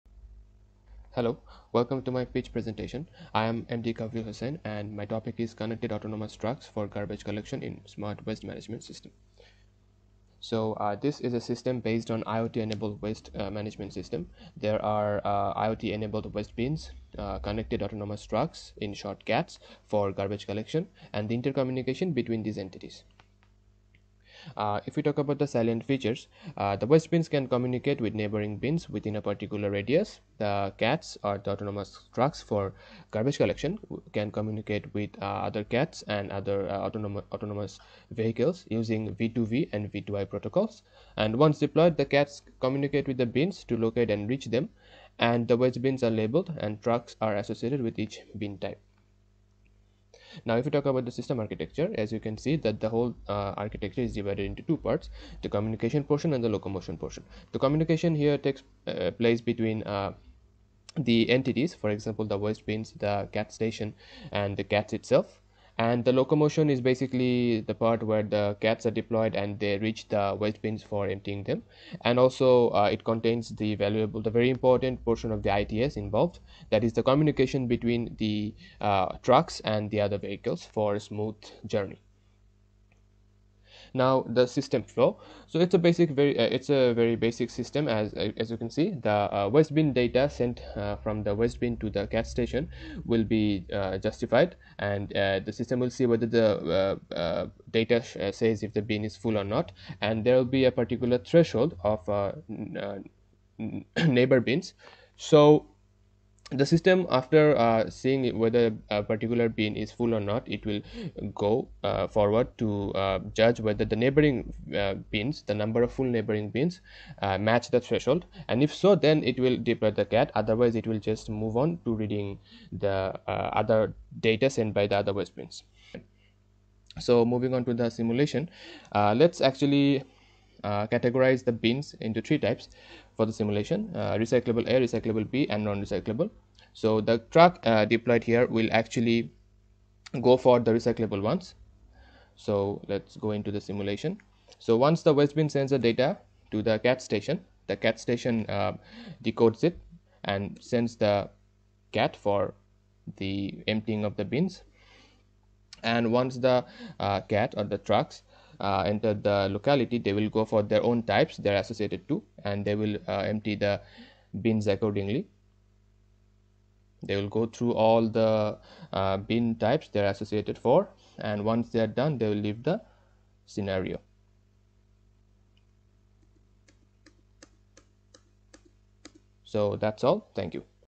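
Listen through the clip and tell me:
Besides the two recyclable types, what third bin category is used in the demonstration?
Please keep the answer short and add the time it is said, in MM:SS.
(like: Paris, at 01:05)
non recyclable, at 02:15.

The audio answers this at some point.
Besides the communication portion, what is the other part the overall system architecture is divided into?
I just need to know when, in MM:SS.
00:56.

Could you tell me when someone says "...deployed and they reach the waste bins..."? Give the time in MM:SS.
01:08.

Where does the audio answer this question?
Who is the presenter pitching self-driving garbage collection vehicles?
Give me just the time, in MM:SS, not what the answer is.
00:03.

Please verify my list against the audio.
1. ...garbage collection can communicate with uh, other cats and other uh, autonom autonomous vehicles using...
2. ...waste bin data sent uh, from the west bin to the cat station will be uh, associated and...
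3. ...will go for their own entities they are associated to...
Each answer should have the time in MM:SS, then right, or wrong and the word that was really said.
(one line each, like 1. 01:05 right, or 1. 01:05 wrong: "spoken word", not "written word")
1. 00:33 right
2. 01:29 wrong: "justified", not "associated"
3. 02:40 wrong: "types", not "entities".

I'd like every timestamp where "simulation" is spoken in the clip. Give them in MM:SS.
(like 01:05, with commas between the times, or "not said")
02:07, 02:13, 02:23.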